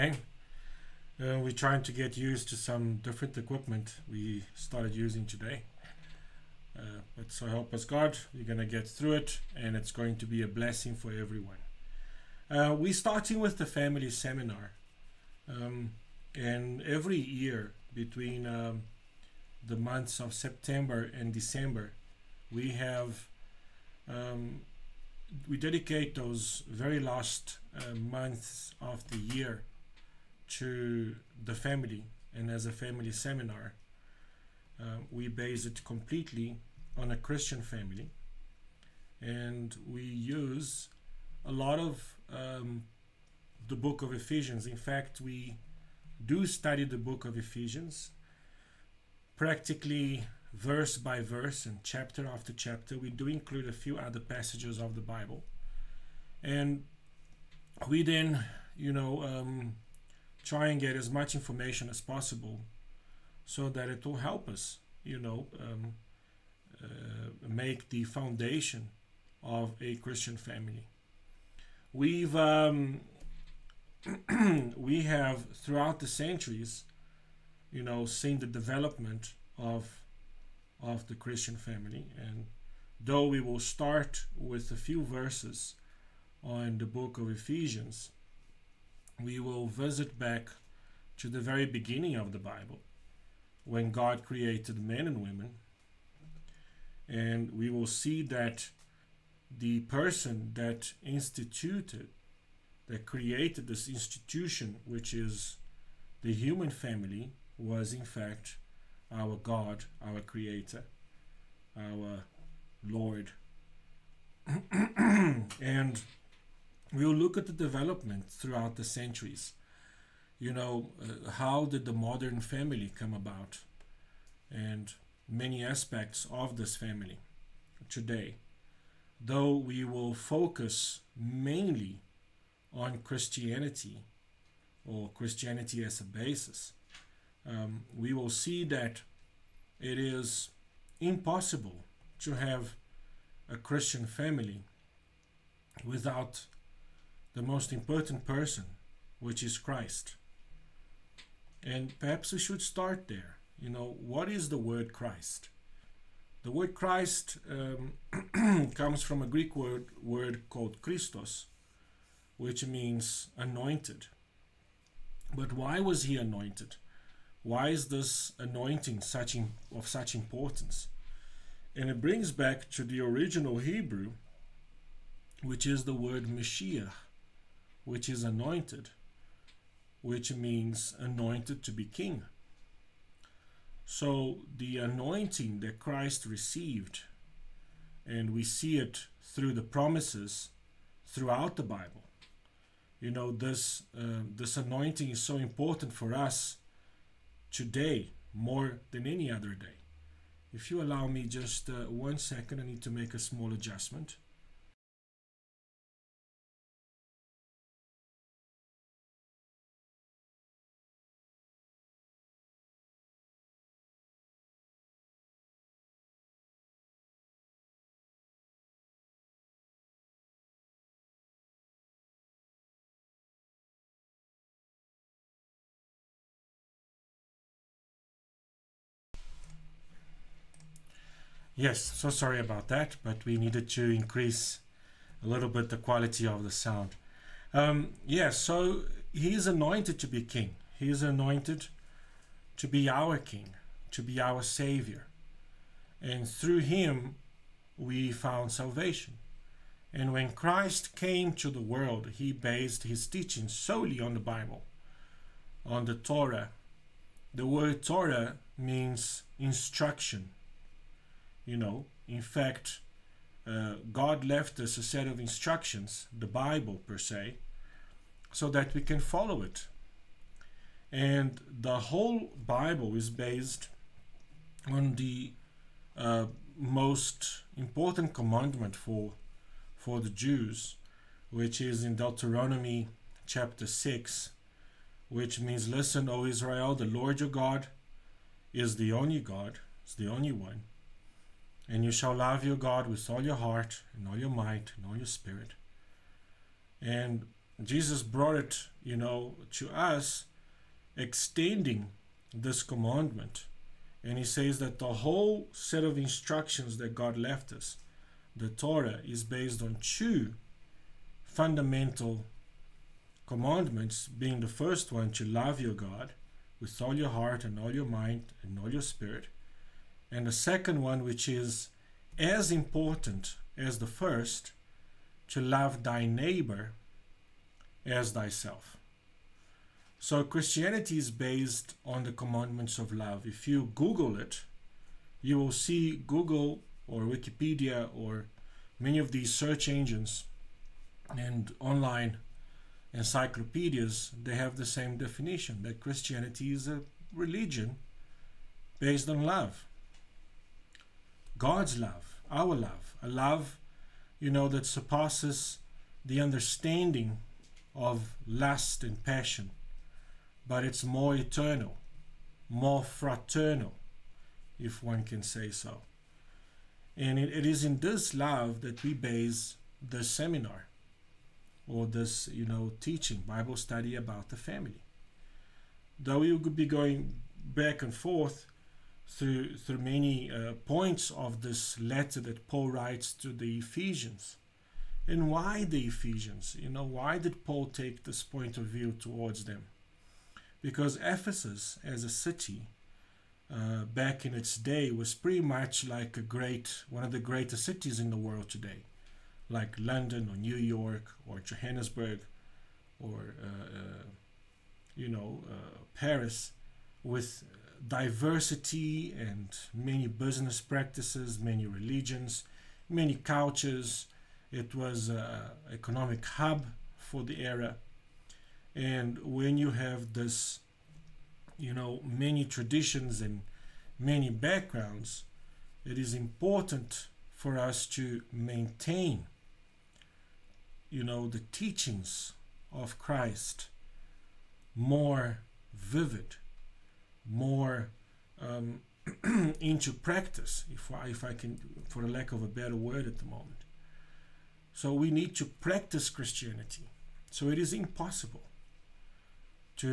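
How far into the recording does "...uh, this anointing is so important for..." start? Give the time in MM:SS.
03:13.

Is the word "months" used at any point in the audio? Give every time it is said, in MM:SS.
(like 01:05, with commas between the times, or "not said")
00:19, 00:27.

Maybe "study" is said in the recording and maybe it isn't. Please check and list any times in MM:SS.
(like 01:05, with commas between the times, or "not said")
00:46, 06:13.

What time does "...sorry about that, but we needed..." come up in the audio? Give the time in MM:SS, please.
03:52.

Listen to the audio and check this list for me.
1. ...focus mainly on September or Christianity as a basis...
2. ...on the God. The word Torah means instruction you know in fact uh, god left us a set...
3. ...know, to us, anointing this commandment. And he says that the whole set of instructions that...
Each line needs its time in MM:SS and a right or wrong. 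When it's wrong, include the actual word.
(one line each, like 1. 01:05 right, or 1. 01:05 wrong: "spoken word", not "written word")
1. 02:10 wrong: "Christianity", not "September"
2. 04:15 wrong: "Torah", not "God"
3. 04:58 wrong: "extending", not "anointing".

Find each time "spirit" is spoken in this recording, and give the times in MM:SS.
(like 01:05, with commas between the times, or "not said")
04:55, 05:18.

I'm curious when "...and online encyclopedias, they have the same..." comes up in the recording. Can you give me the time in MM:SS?
05:41.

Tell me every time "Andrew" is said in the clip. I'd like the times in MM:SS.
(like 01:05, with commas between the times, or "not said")
not said.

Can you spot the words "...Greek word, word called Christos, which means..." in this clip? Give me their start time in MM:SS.
02:39.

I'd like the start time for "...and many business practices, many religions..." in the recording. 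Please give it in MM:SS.
06:49.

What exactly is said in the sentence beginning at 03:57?
Um, yeah, so he is anointed to be king.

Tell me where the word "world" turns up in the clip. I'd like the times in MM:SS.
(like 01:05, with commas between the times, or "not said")
04:11, 06:38.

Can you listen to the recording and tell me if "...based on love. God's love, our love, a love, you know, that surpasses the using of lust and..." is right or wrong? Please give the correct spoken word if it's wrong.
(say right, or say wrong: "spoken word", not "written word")
wrong: "understanding", not "using".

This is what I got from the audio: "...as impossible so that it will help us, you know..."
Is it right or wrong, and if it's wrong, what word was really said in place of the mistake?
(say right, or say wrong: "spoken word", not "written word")
wrong: "possible", not "impossible".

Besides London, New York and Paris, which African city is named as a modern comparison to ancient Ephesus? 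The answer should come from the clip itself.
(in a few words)
Johannesburg.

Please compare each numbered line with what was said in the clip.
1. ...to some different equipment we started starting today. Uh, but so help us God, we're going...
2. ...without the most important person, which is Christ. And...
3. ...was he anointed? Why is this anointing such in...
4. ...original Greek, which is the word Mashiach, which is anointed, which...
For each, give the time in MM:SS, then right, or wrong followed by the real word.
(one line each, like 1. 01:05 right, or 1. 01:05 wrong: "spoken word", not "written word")
1. 00:02 wrong: "using", not "starting"
2. 02:25 right
3. 02:45 right
4. 02:52 wrong: "Hebrew", not "Greek".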